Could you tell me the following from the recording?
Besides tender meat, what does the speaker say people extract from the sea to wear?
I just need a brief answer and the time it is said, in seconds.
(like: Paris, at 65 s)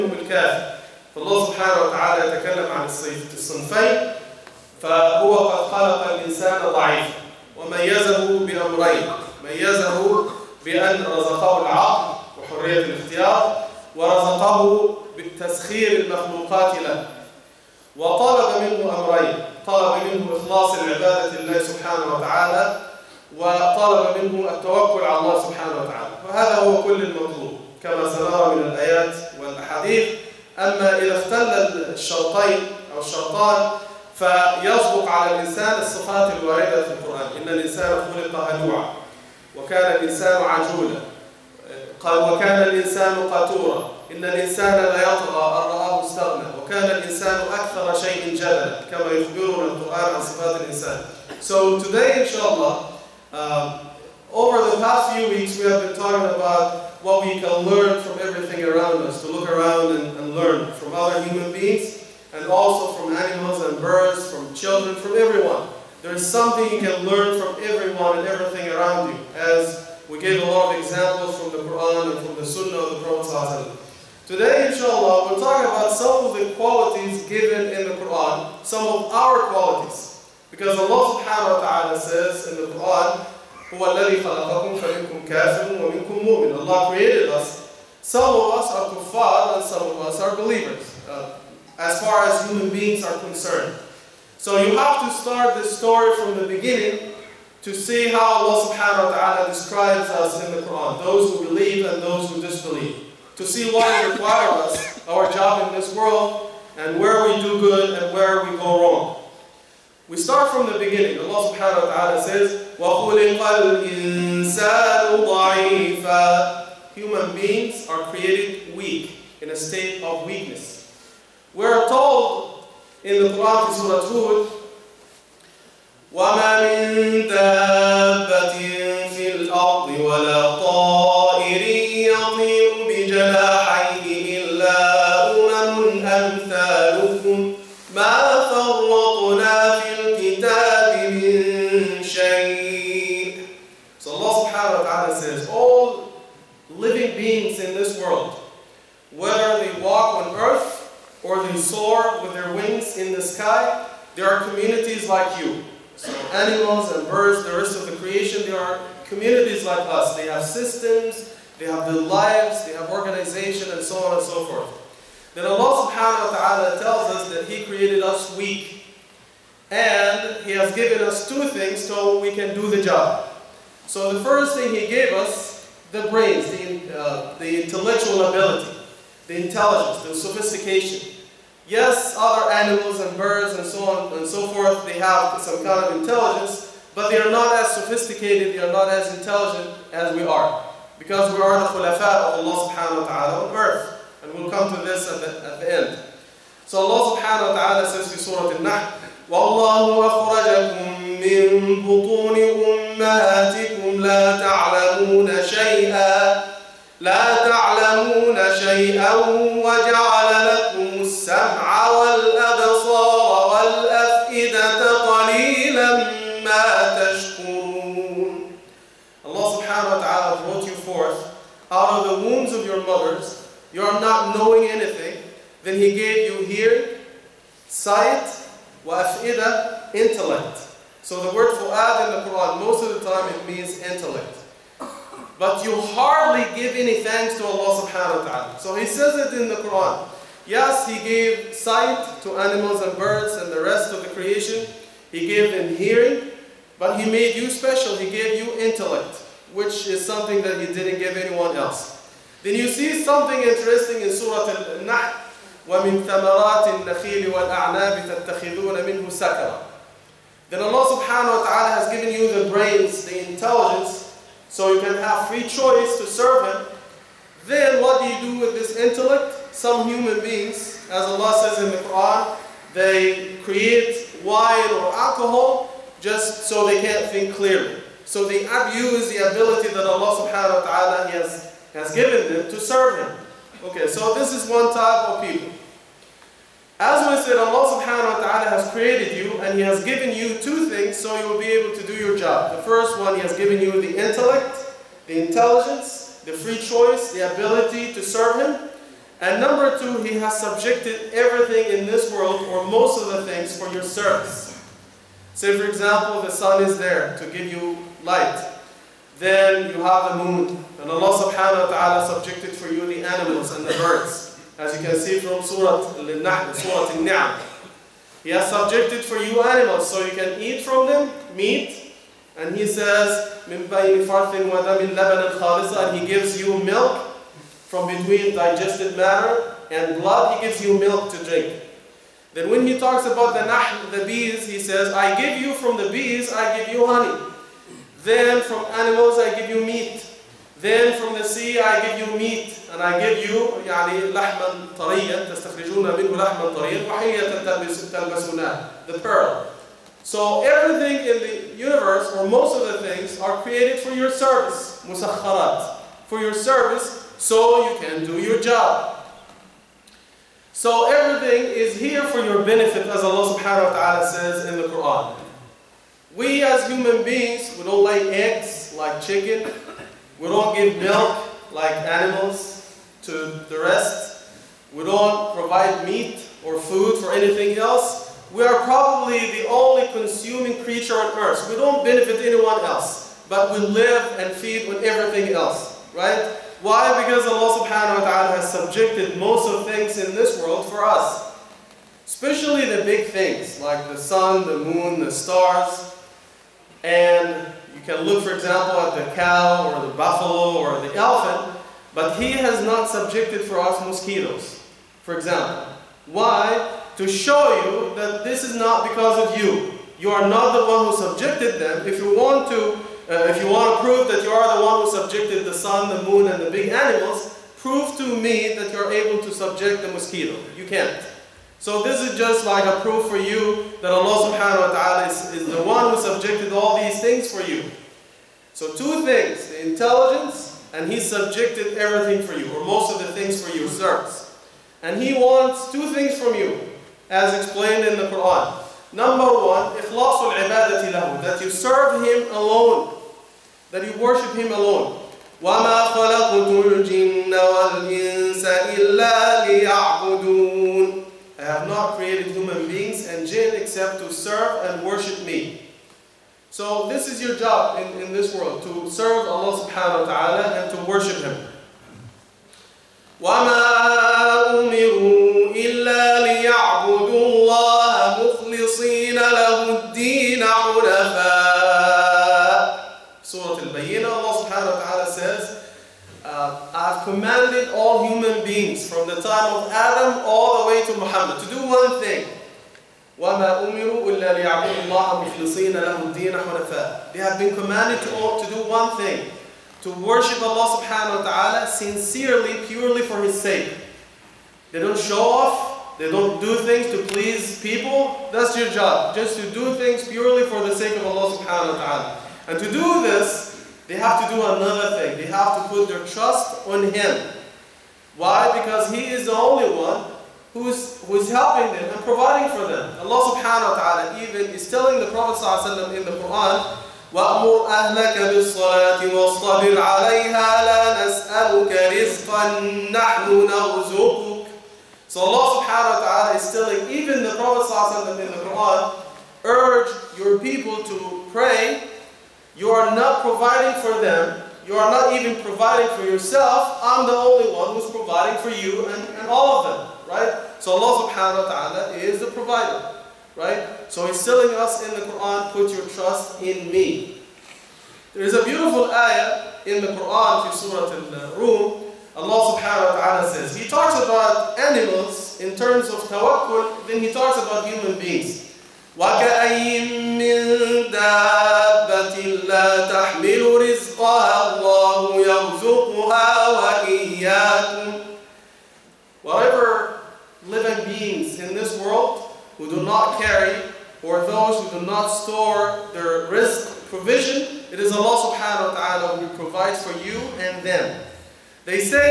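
the pearl, at 348 s.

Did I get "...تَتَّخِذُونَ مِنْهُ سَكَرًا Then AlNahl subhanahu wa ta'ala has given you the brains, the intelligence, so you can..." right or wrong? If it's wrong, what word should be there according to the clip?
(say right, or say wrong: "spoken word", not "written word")
wrong: "Allah", not "AlNahl".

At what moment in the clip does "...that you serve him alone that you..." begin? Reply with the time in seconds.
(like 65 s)
441 s.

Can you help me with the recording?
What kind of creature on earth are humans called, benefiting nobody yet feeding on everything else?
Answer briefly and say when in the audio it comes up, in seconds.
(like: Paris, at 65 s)
consuming, at 379 s.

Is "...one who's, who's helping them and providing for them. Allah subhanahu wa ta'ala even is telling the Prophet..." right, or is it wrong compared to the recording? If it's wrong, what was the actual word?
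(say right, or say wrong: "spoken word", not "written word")
right.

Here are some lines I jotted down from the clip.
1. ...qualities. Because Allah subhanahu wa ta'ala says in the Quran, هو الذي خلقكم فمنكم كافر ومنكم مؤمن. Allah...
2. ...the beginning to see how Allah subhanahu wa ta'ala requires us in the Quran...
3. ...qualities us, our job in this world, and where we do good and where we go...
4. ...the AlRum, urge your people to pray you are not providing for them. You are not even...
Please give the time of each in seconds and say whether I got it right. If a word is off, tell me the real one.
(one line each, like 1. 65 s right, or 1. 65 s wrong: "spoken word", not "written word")
1. 79 s right
2. 96 s wrong: "describes", not "requires"
3. 104 s wrong: "requires", not "qualities"
4. 528 s wrong: "Quran", not "AlRum".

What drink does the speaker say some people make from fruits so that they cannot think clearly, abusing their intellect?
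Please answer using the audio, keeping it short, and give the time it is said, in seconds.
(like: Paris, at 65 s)
wine or alcohol, at 274 s.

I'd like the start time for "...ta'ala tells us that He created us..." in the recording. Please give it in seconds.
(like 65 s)
166 s.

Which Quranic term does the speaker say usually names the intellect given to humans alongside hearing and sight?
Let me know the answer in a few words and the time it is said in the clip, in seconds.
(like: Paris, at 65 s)
fu'ad, at 231 s.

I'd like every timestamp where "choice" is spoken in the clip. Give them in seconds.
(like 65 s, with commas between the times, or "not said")
265 s, 296 s.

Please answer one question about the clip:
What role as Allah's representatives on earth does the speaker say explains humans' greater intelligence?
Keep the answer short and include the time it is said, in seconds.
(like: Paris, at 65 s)
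khulafa, at 191 s.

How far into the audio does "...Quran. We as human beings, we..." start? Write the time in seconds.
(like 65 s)
364 s.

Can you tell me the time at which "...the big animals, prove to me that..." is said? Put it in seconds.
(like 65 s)
416 s.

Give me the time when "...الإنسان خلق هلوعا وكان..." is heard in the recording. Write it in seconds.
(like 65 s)
37 s.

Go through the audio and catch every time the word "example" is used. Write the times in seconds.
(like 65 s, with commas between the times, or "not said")
70 s, 305 s, 398 s, 405 s.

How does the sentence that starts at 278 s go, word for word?
So they abuse the ability that Allah subhanahu wa ta'ala has, has given them to serve Him.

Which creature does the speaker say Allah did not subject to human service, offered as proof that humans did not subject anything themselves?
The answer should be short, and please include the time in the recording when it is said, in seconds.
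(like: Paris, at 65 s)
mosquitoes, at 403 s.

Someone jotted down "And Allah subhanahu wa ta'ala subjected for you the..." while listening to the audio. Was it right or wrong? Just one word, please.
right.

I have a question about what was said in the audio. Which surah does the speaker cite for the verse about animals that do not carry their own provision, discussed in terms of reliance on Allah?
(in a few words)
Surah Al-Rum.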